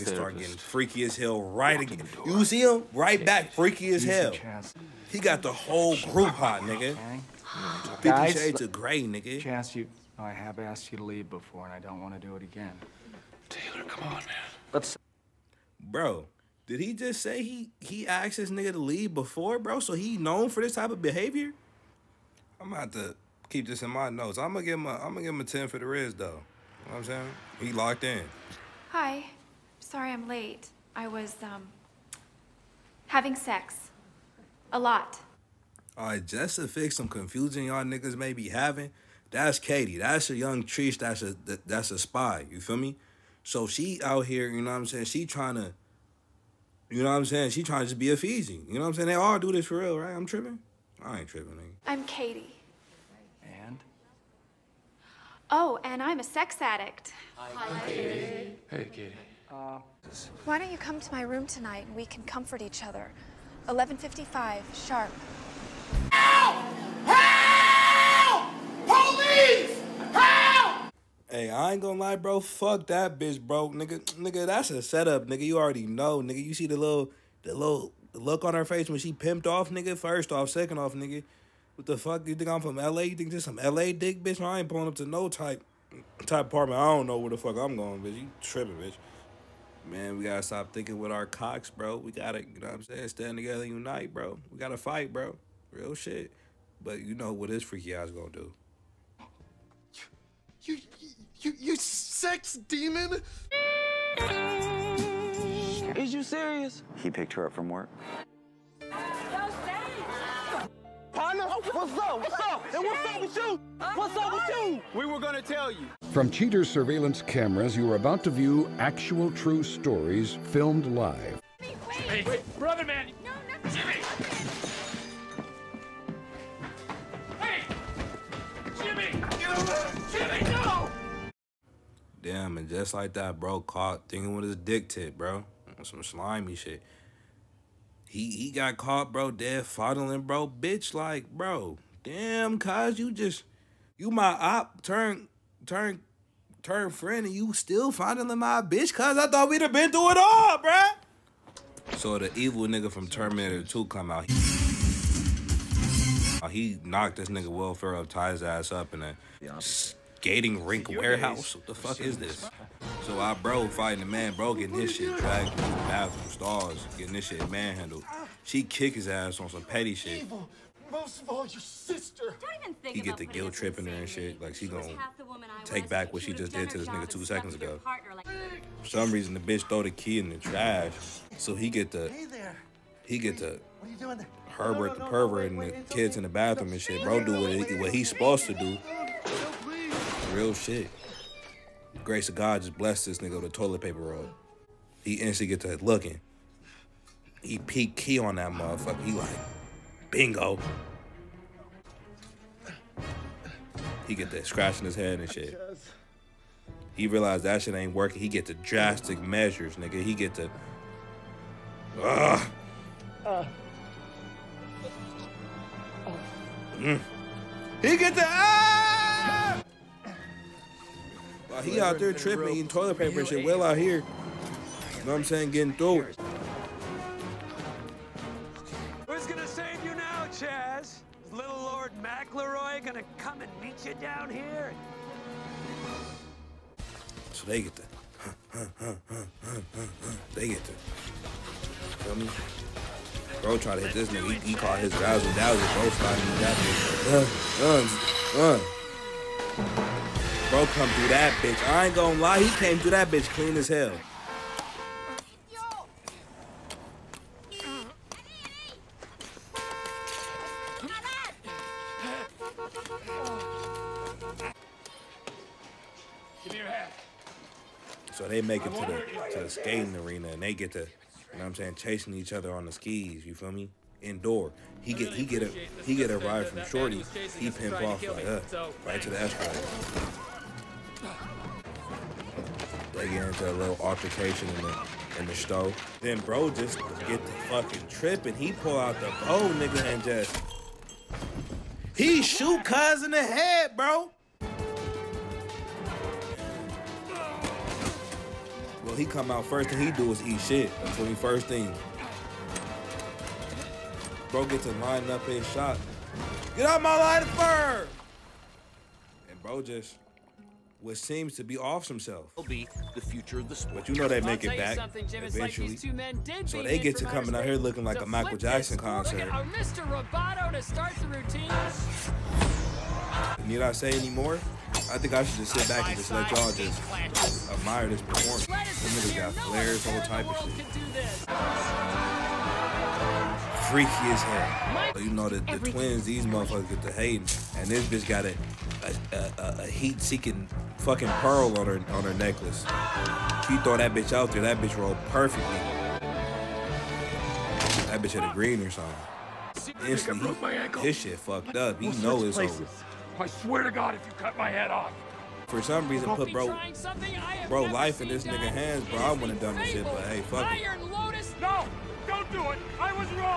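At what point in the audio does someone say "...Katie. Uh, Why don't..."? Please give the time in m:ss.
0:58.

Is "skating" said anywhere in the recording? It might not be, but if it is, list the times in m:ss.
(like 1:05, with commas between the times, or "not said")
2:39, 4:29.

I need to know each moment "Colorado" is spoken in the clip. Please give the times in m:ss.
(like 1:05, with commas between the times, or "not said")
not said.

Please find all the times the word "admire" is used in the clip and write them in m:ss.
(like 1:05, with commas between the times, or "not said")
5:27.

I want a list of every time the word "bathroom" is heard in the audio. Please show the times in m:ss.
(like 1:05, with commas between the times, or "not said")
2:45, 3:06.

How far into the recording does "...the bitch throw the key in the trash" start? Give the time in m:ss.
2:59.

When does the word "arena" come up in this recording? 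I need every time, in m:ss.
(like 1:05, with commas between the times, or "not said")
4:29.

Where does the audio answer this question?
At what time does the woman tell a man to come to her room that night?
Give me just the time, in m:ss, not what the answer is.
1:03.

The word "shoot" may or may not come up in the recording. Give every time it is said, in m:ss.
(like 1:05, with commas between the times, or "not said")
4:52.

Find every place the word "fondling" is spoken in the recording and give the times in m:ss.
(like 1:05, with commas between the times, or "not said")
2:19, 2:27.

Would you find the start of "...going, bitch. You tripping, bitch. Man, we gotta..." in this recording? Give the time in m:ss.
1:27.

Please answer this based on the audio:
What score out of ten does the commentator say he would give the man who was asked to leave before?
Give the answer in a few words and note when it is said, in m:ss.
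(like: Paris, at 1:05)
10, at 0:25.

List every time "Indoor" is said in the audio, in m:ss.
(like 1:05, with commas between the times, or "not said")
4:34.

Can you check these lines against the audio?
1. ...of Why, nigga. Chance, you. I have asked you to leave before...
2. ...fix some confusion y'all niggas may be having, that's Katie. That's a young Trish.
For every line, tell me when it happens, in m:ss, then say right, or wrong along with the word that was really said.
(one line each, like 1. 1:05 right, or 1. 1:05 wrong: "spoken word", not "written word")
1. 0:08 wrong: "Grey", not "Why"
2. 0:36 right.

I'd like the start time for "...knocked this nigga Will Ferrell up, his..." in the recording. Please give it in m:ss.
2:36.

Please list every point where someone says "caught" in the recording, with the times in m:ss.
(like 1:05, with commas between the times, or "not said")
2:13, 2:18, 4:04.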